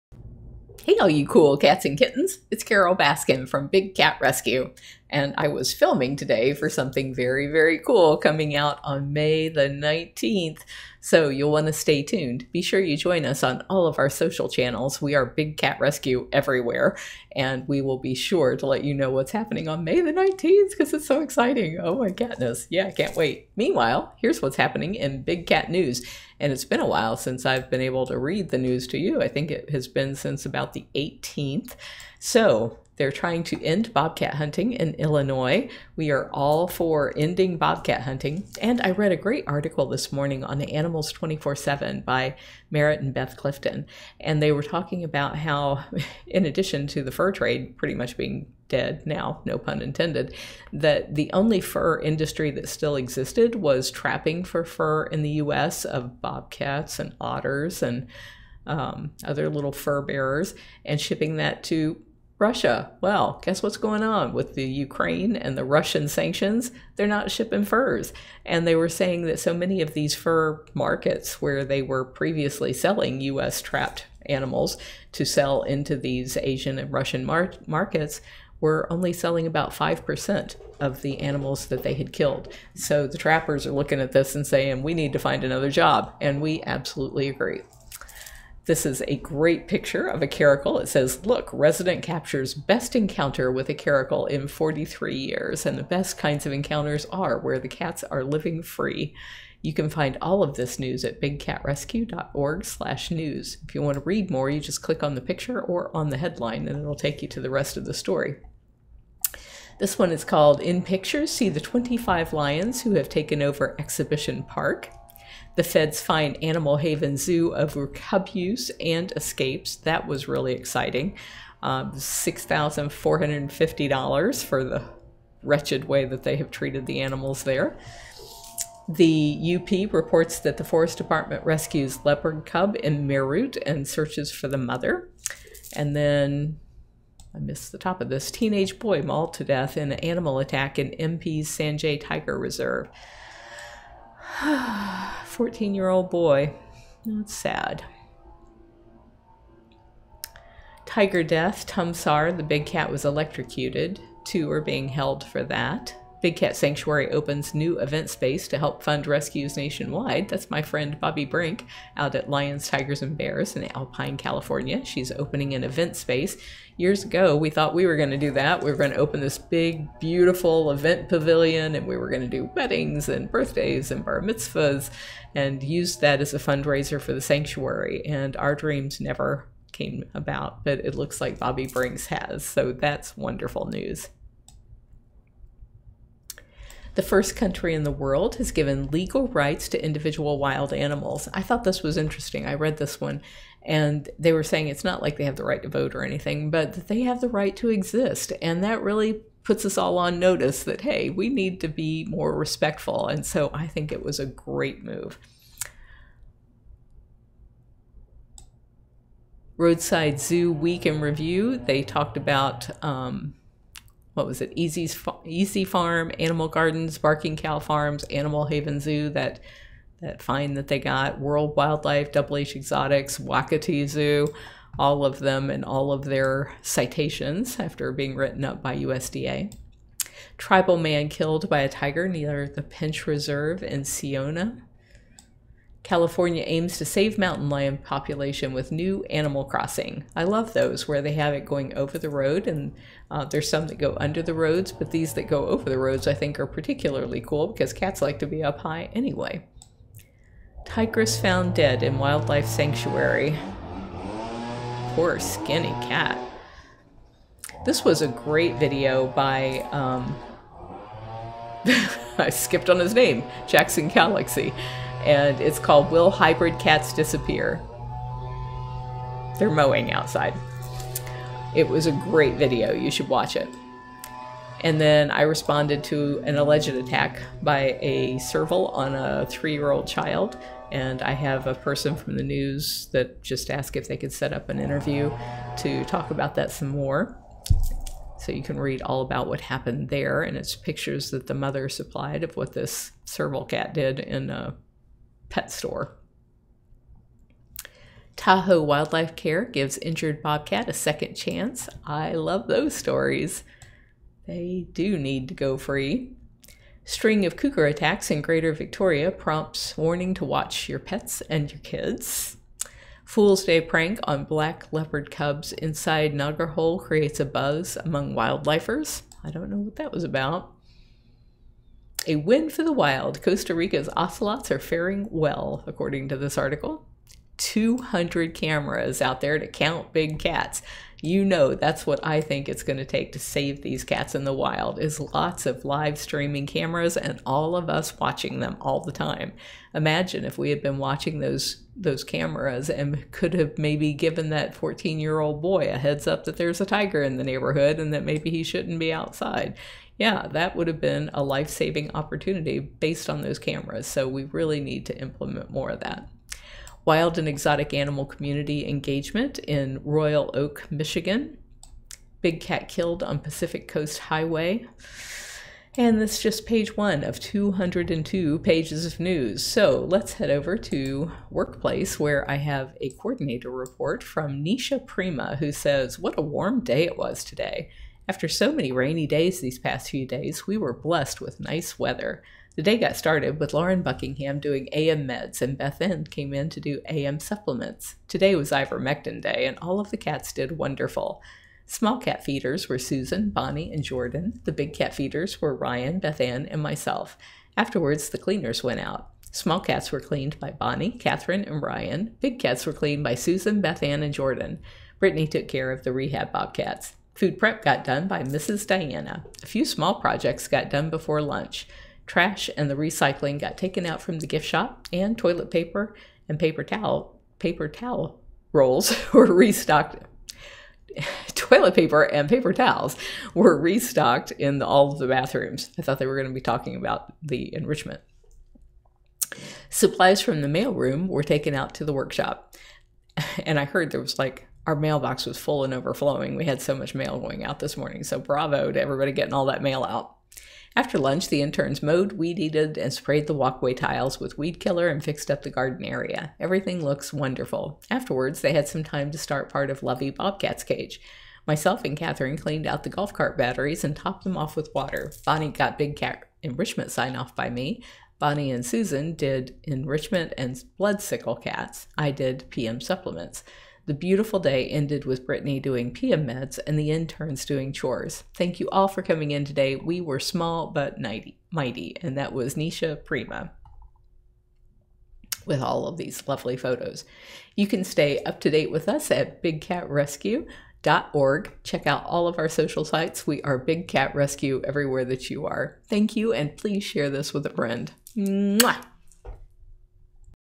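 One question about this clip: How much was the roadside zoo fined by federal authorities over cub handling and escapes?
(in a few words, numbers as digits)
$6,450.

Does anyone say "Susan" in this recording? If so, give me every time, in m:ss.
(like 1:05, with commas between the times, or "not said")
6:32, 6:43, 7:38.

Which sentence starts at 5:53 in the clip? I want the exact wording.
So we really need to implement more of that.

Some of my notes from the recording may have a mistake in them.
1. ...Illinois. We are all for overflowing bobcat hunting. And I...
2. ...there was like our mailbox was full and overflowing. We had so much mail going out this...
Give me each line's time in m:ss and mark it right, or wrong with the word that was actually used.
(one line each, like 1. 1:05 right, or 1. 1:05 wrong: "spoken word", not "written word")
1. 0:34 wrong: "ending", not "overflowing"
2. 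7:13 right.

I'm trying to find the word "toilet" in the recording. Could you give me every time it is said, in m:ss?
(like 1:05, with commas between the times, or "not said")
6:55, 7:01.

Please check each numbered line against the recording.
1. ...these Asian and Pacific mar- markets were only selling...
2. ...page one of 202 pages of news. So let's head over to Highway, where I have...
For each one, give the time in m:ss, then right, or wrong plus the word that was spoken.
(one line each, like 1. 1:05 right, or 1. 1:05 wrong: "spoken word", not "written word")
1. 1:15 wrong: "Russian", not "Pacific"
2. 6:06 wrong: "Workplace", not "Highway".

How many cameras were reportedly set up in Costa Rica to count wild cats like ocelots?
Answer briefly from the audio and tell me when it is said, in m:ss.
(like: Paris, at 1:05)
200, at 5:27.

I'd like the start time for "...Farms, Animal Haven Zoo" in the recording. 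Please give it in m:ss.
3:37.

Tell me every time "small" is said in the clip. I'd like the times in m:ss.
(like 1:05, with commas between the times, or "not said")
6:31, 6:39, 6:49, 7:50.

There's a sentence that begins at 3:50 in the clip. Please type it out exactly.
Tribal man killed by a tiger near the Pench Reserve in Seoni.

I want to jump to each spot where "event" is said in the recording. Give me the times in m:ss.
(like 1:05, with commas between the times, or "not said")
2:37, 2:45, 2:50.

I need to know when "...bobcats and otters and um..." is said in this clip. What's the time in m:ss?
0:56.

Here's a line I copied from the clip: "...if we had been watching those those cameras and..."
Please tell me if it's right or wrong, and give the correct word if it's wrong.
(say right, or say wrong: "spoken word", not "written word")
right.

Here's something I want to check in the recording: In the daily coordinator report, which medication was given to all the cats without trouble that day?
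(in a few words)
ivermectin.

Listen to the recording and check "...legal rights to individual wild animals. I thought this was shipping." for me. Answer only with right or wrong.
wrong.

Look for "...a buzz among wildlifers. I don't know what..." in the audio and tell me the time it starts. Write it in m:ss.
5:17.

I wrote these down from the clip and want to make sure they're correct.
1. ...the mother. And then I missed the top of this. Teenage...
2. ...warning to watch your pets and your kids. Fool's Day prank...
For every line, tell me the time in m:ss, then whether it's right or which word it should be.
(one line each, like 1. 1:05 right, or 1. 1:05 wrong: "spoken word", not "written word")
1. 2:14 right
2. 5:09 right.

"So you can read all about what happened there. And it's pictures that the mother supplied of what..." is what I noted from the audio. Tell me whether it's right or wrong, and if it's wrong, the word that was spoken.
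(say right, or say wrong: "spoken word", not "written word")
right.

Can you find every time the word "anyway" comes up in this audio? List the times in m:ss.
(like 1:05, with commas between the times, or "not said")
4:08.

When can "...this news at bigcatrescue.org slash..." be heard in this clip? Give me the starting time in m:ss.
1:40.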